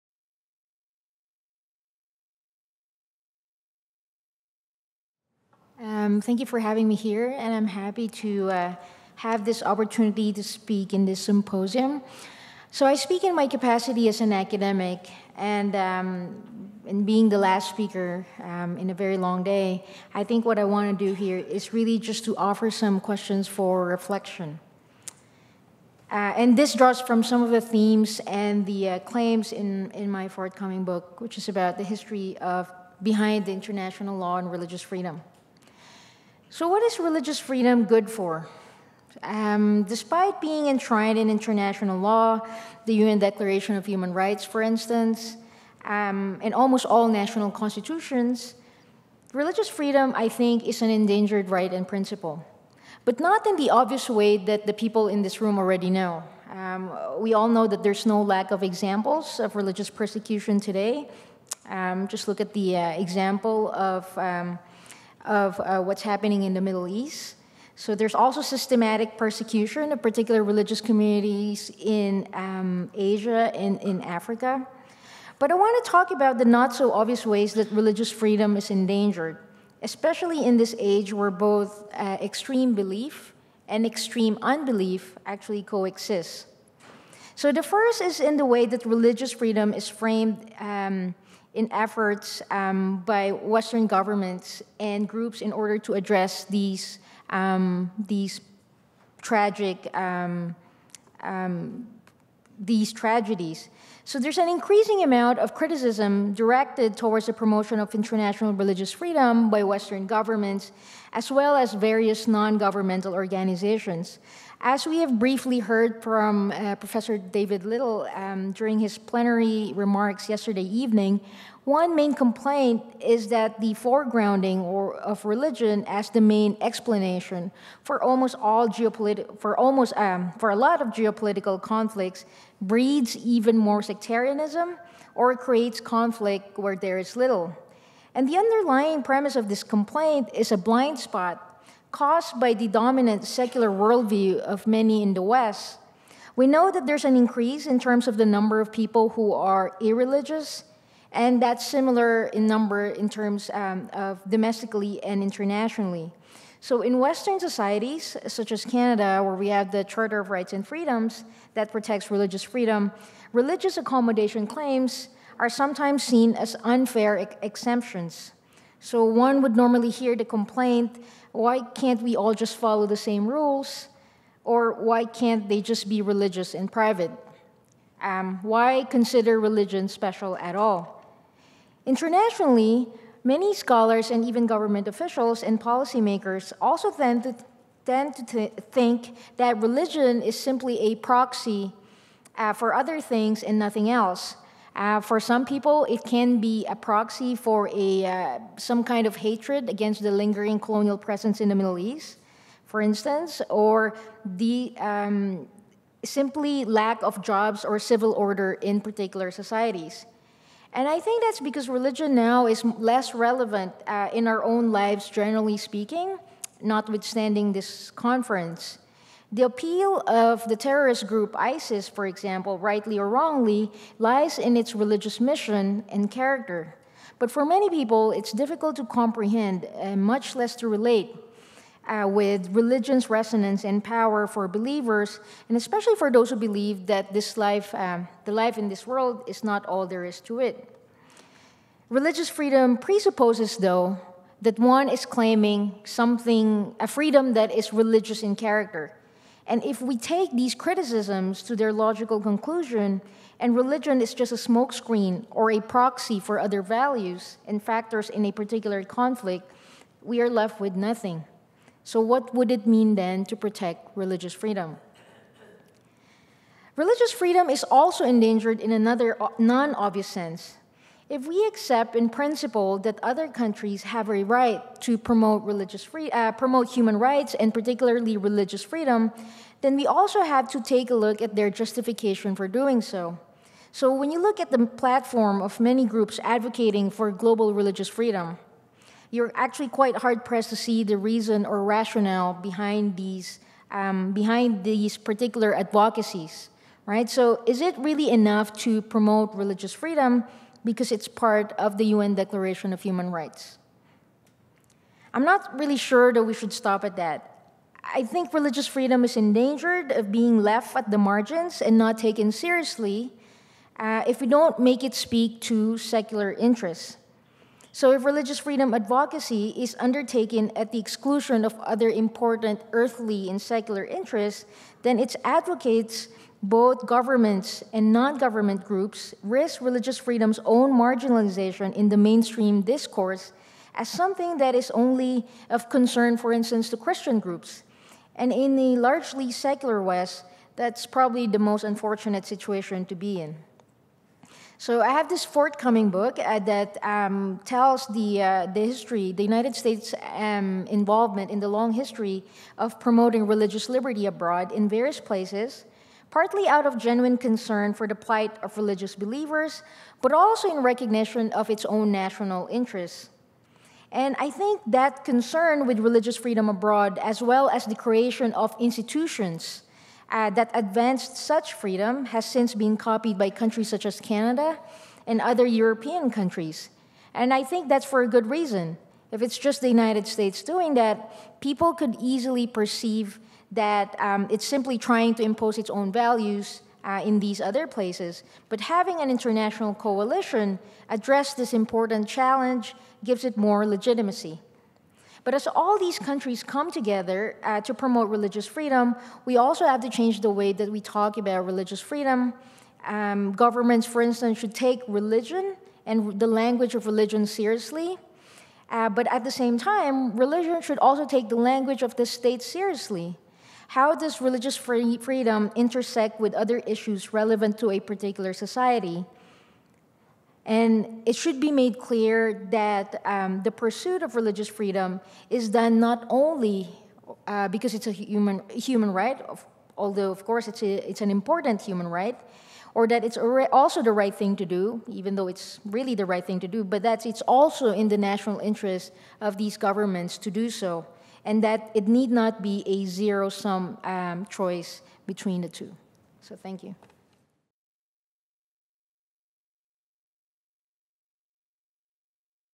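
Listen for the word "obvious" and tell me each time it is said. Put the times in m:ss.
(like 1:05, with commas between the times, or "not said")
0:53, 1:16, 4:29.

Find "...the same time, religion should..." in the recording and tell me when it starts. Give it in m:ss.
6:49.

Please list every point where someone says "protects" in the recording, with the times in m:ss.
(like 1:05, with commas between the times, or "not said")
2:41, 4:23.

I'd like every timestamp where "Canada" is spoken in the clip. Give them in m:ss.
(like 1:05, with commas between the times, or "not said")
2:38, 6:13.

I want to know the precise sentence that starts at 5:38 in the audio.
And in the largely secular West, that's probably the most unfortunate situation to be in.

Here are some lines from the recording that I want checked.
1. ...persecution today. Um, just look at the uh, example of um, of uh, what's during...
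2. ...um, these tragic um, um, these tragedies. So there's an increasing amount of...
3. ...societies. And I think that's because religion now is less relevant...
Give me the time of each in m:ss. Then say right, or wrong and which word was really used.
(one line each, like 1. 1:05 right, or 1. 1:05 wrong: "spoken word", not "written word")
1. 0:59 wrong: "happening", not "during"
2. 1:37 right
3. 3:29 right.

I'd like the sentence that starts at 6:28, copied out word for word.
But having an international coalition address this important challenge gives it more legitimacy.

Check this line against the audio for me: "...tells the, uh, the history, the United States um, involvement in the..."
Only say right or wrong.
right.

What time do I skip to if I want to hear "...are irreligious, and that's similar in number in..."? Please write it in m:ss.
2:29.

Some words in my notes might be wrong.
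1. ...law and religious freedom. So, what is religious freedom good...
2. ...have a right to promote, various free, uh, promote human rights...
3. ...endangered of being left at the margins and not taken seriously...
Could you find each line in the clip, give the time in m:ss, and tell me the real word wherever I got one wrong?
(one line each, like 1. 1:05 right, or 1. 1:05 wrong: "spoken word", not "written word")
1. 0:34 right
2. 4:33 wrong: "religious", not "various"
3. 5:09 right.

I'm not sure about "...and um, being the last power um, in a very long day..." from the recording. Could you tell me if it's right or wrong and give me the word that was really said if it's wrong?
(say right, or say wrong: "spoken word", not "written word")
wrong: "speaker", not "power".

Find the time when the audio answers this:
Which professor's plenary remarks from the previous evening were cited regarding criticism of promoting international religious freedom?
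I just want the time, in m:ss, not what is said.
1:57.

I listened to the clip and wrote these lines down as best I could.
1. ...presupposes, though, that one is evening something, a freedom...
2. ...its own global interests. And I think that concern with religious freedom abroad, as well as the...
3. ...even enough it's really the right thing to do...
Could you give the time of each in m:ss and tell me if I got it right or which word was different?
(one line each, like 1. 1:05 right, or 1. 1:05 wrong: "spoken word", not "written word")
1. 4:02 wrong: "claiming", not "evening"
2. 6:01 wrong: "national", not "global"
3. 7:14 wrong: "though", not "enough".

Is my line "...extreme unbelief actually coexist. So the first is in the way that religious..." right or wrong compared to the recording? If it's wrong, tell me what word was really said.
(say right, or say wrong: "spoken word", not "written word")
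right.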